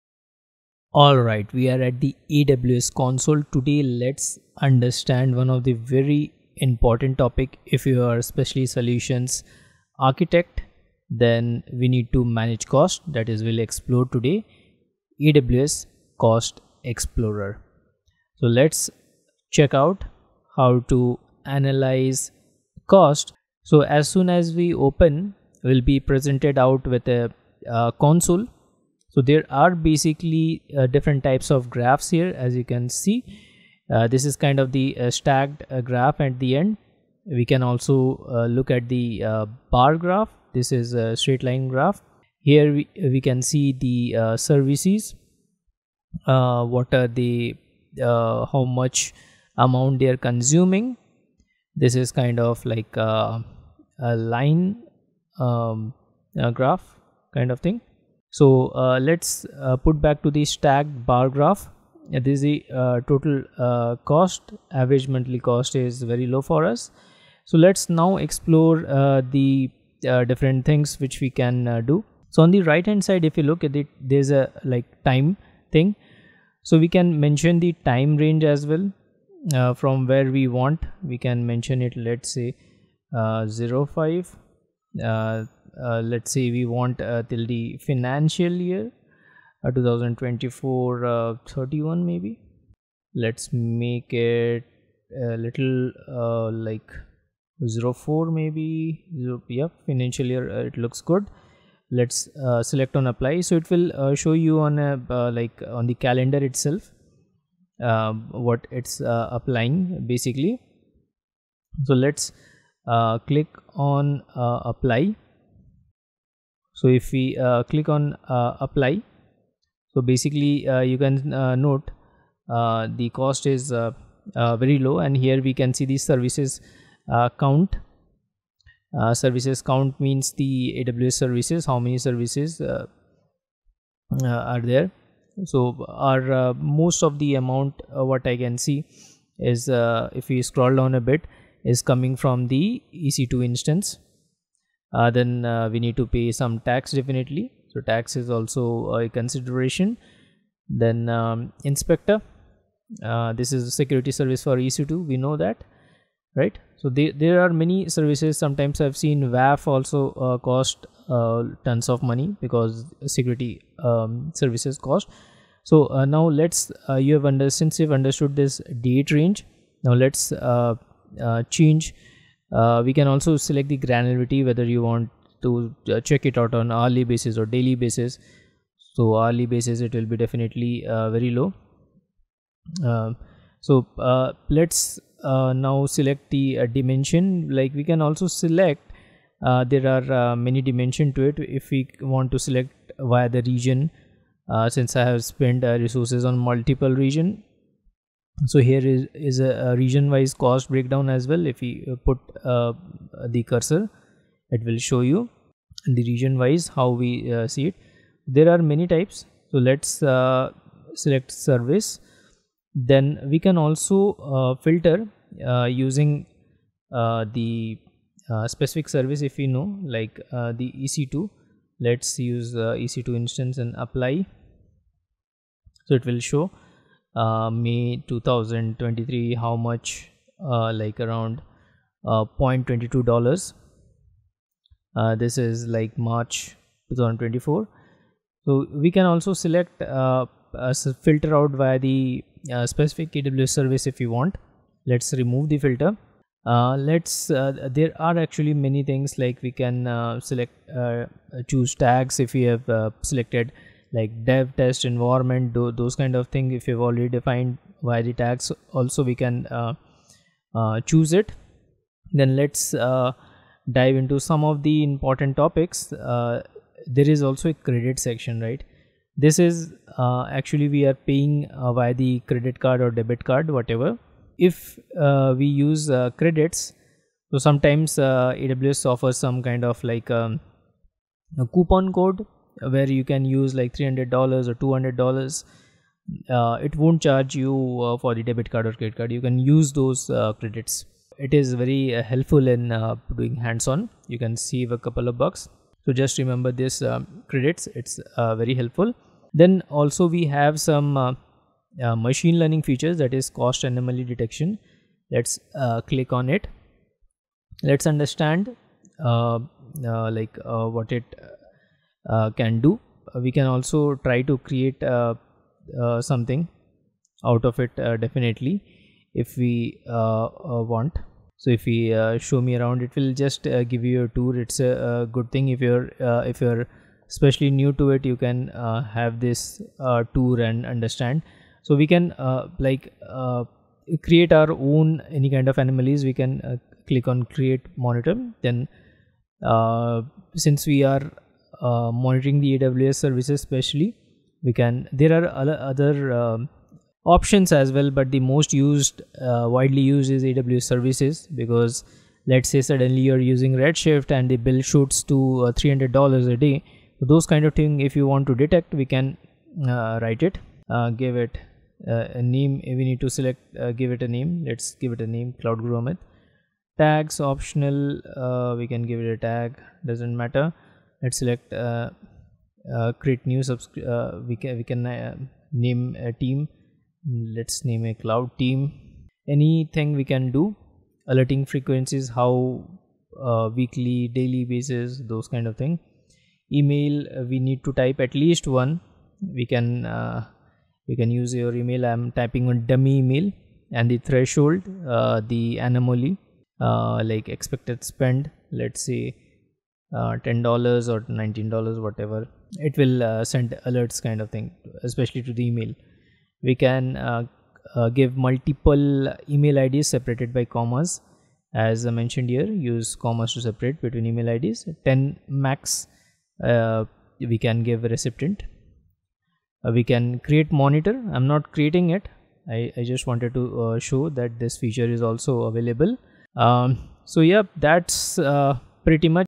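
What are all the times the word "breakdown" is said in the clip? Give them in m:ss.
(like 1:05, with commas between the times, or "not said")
3:20.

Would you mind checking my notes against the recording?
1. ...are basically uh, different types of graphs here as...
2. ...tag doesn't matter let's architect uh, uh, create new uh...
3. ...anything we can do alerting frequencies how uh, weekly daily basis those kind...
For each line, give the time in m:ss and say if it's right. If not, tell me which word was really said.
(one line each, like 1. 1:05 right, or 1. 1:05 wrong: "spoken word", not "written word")
1. 0:29 right
2. 6:09 wrong: "select", not "architect"
3. 6:19 right.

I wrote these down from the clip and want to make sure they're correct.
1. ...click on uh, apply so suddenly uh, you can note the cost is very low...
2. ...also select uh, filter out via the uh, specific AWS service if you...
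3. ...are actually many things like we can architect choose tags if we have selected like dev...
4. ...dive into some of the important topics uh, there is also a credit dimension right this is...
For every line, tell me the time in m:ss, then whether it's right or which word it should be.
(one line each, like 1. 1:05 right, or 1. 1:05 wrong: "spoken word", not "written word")
1. 1:57 wrong: "basically", not "suddenly"
2. 3:59 right
3. 4:07 wrong: "select", not "architect"
4. 4:23 wrong: "section", not "dimension".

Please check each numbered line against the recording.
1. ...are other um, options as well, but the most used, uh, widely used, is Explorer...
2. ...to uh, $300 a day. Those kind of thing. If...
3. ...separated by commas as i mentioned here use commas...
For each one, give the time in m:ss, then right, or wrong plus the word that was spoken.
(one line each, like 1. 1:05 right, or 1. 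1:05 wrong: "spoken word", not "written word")
1. 5:45 wrong: "AWS", not "Explorer"
2. 5:55 right
3. 6:49 right.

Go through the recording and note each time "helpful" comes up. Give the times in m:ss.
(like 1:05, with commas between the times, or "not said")
4:52, 4:58.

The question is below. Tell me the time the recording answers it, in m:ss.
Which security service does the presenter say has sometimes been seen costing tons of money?
2:39.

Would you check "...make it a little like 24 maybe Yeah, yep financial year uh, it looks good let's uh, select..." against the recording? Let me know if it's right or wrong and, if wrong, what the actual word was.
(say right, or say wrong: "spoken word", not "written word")
wrong: "04", not "24".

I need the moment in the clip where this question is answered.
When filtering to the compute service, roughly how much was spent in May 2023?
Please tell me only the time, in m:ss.
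3:52.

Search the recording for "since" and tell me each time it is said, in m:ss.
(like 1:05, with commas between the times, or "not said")
2:47, 3:14, 5:40.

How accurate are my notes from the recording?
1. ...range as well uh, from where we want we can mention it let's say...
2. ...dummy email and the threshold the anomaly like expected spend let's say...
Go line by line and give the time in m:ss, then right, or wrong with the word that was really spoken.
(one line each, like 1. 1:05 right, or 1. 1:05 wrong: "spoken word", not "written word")
1. 1:18 right
2. 6:32 right.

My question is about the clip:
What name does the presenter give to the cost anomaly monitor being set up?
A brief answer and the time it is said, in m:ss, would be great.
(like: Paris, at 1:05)
Cloud Guru Amit, at 6:05.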